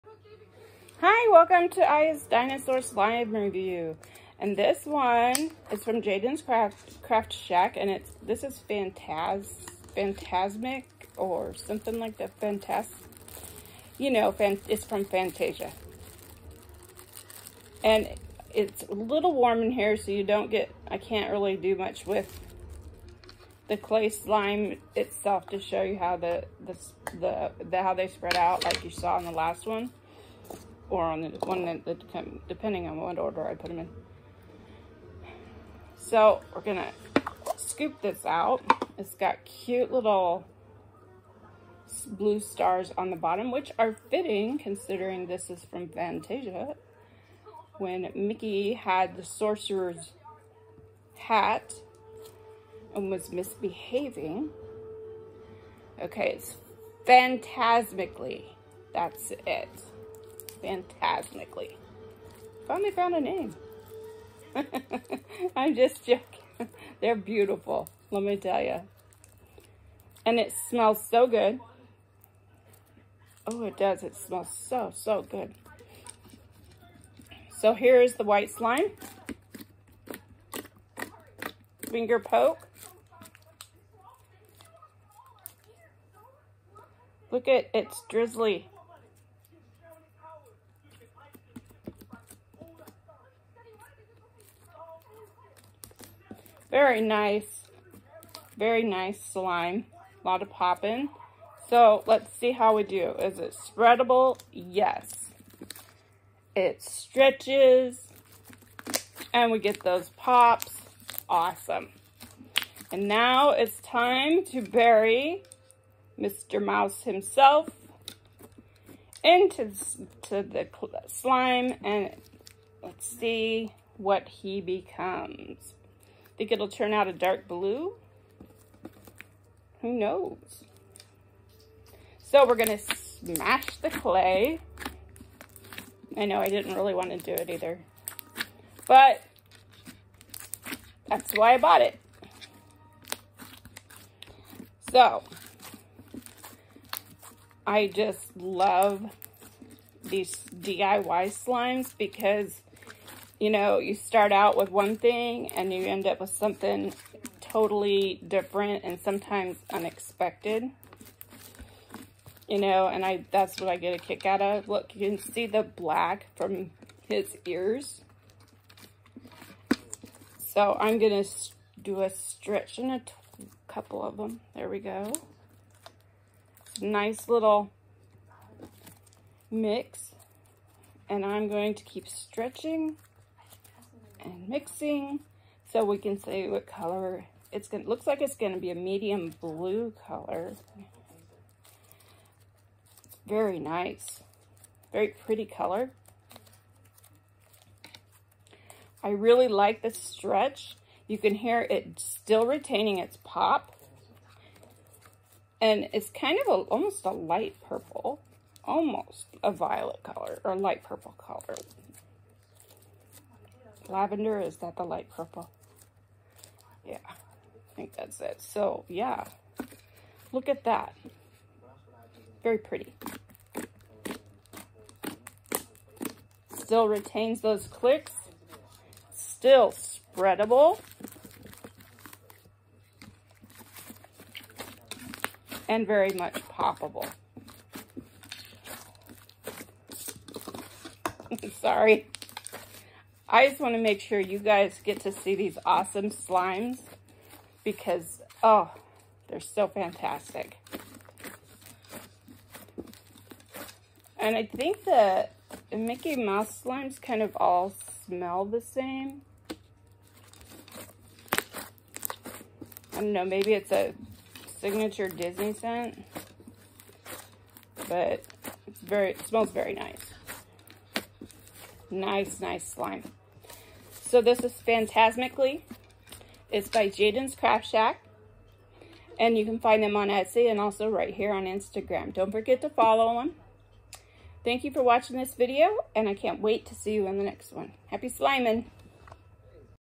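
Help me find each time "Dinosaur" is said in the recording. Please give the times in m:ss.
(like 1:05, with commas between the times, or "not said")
0:02.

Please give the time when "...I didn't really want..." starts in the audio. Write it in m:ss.
2:16.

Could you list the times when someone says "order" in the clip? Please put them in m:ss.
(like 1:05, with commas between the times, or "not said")
0:33.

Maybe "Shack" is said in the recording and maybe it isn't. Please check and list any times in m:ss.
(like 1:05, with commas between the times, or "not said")
0:07, 4:37.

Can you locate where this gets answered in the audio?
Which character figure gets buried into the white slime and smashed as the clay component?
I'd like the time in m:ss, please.
1:56.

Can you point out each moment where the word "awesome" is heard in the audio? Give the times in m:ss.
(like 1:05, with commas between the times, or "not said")
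1:51, 4:05.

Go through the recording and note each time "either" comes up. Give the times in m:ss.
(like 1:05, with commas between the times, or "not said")
2:17.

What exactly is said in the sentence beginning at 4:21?
I don't know, maybe it's a signature Disney scent, but it's very, it smells very nice.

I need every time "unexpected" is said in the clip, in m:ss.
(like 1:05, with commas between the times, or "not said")
2:39.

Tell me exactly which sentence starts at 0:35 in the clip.
So we're gonna scoop this out.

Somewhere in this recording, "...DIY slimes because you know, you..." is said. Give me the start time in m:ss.
2:30.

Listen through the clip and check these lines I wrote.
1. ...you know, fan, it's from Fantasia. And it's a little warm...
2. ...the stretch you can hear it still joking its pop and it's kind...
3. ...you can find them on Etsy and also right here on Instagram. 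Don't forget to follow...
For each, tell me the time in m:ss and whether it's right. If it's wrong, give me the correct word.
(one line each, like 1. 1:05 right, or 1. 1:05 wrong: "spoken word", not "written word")
1. 0:13 right
2. 3:19 wrong: "retaining", not "joking"
3. 4:39 right.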